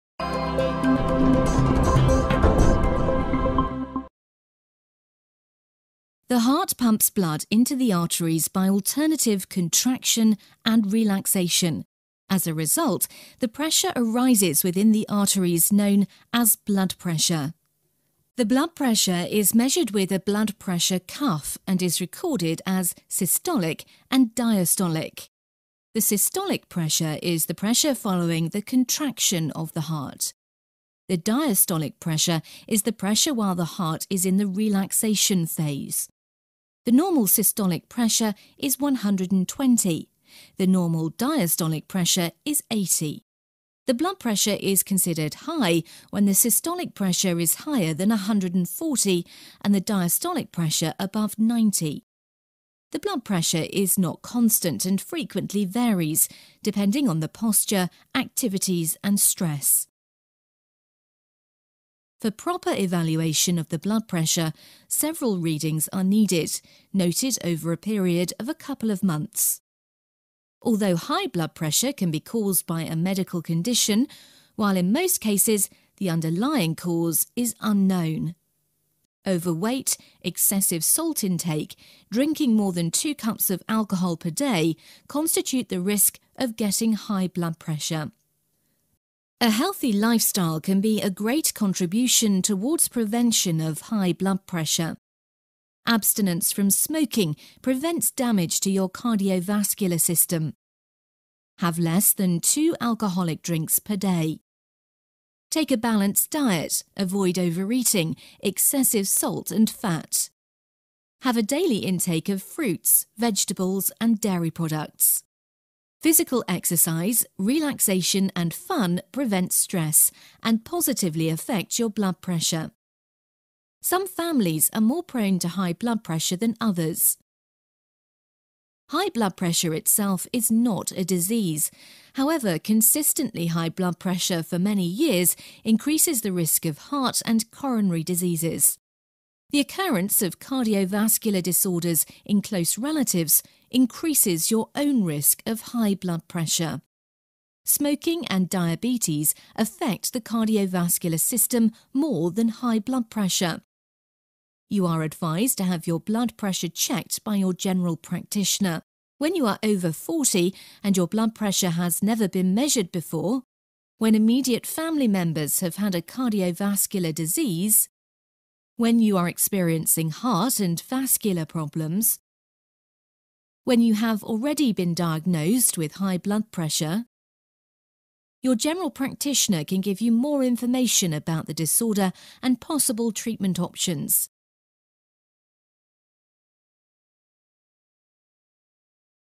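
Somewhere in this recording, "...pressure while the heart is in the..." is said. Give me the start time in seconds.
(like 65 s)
32 s.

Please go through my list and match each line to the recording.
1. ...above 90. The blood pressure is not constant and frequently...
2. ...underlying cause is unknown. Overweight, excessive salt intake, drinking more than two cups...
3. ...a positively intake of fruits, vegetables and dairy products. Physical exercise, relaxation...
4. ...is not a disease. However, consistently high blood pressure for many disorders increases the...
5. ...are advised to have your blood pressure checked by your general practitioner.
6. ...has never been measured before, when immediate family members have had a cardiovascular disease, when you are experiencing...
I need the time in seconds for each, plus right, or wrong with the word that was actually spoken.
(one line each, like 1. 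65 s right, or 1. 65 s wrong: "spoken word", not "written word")
1. 50 s right
2. 76 s right
3. 111 s wrong: "daily", not "positively"
4. 130 s wrong: "years", not "disorders"
5. 154 s right
6. 161 s right.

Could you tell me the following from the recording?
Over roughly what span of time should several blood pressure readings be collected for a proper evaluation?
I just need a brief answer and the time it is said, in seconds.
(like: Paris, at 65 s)
a couple of months, at 68 s.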